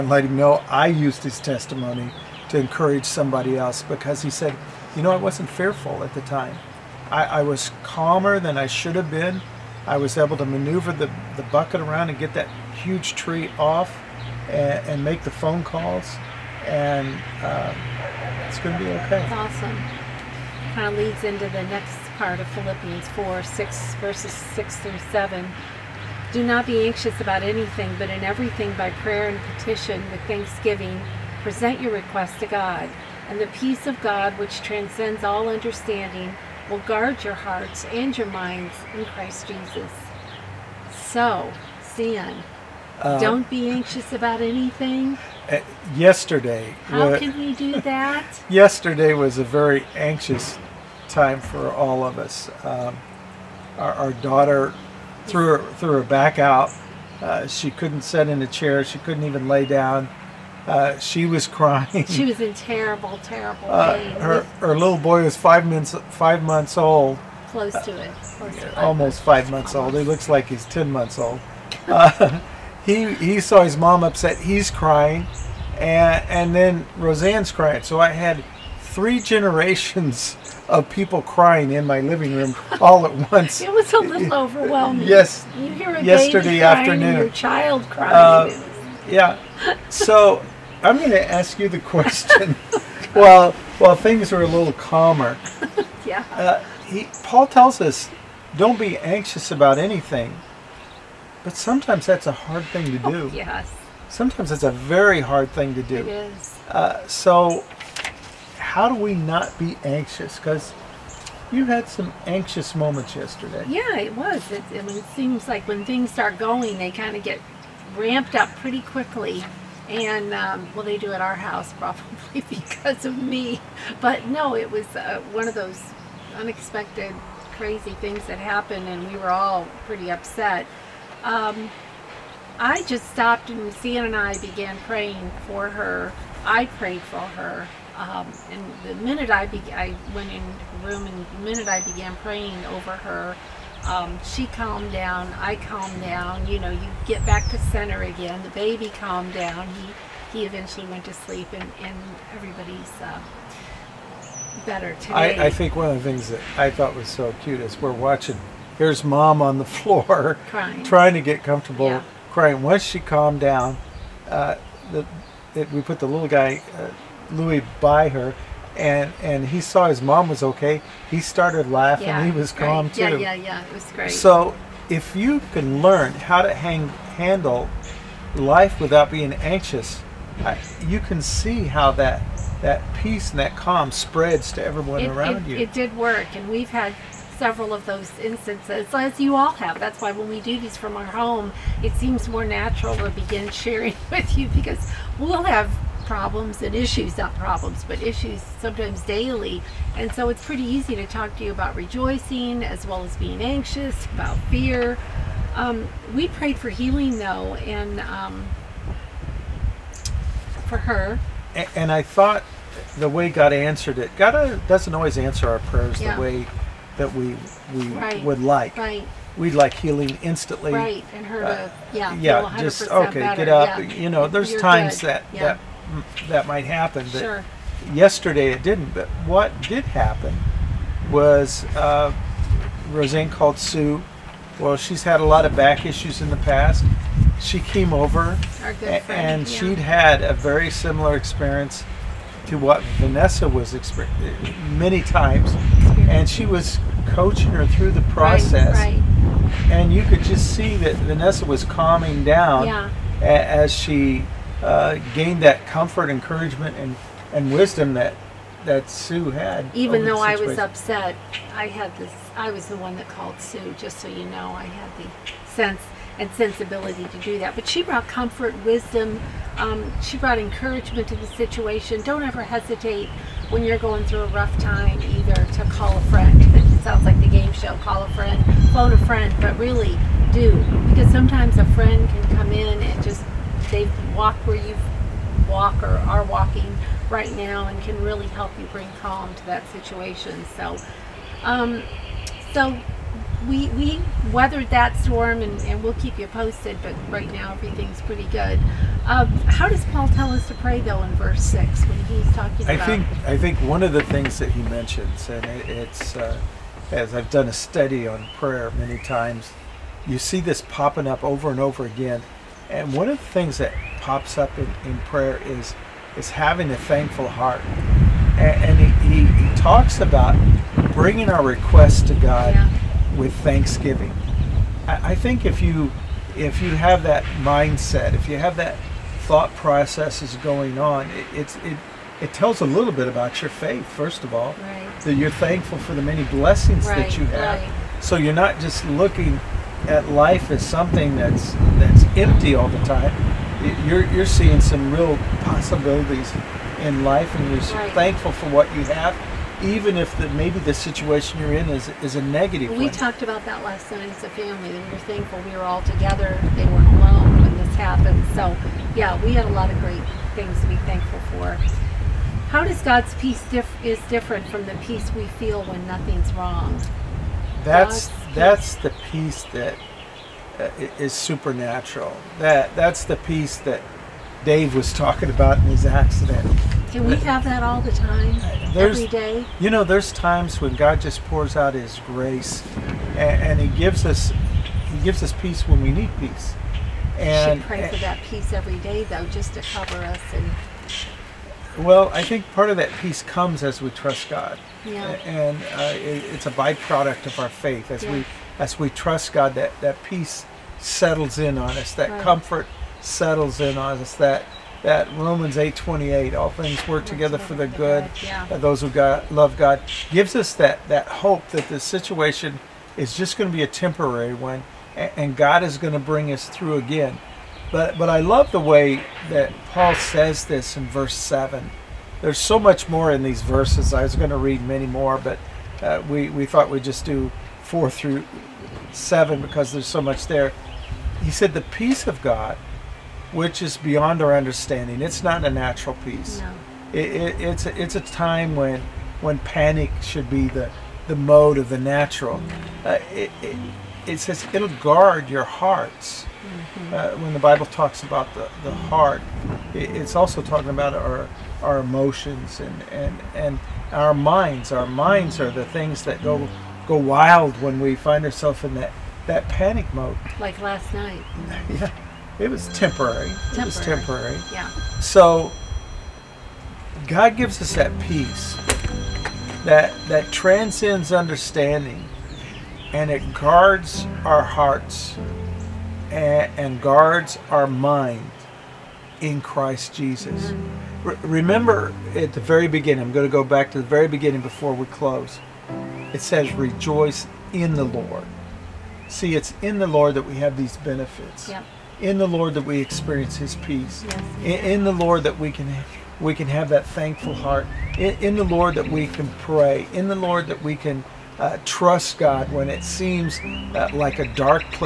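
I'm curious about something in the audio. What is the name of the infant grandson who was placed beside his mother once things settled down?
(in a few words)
Louis.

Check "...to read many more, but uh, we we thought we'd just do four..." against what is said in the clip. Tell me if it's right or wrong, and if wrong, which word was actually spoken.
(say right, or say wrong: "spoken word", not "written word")
right.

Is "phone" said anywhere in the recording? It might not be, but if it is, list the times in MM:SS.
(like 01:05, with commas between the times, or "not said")
00:15, 04:38.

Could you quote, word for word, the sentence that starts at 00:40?
So, see uh, Don't be anxious about anything.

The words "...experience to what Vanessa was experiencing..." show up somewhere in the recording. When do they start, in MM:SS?
04:01.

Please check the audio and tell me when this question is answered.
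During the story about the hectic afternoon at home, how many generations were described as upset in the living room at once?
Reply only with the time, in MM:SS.
01:18.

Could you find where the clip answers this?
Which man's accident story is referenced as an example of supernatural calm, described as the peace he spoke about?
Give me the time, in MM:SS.
06:14.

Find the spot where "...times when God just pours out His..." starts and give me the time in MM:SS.
06:20.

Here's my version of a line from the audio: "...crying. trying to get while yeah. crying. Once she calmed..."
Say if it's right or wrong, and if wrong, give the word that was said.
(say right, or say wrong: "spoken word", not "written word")
wrong: "comfortable", not "while".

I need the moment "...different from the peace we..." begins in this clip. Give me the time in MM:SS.
06:04.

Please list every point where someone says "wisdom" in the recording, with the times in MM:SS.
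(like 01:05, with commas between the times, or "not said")
04:17, 04:28.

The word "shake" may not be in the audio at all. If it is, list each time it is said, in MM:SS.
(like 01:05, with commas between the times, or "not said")
not said.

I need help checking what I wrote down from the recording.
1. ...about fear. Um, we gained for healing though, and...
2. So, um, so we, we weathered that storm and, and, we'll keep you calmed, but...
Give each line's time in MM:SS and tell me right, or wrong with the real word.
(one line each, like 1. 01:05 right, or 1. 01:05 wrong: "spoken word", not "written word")
1. 03:24 wrong: "prayed", not "gained"
2. 04:50 wrong: "posted", not "calmed".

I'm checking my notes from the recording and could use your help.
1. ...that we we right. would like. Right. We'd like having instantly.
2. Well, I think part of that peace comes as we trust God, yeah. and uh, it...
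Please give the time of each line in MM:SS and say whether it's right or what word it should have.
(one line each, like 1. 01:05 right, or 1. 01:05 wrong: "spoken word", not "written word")
1. 03:36 wrong: "healing", not "having"
2. 06:31 right.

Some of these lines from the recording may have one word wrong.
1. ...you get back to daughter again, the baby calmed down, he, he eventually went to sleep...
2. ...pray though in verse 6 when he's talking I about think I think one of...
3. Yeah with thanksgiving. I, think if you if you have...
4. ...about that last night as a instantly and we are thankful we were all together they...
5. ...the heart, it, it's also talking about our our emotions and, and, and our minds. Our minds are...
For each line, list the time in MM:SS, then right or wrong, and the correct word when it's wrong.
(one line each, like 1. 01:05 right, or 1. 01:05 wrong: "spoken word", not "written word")
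1. 02:26 wrong: "center", not "daughter"
2. 05:00 right
3. 05:22 right
4. 05:53 wrong: "family", not "instantly"
5. 07:28 right.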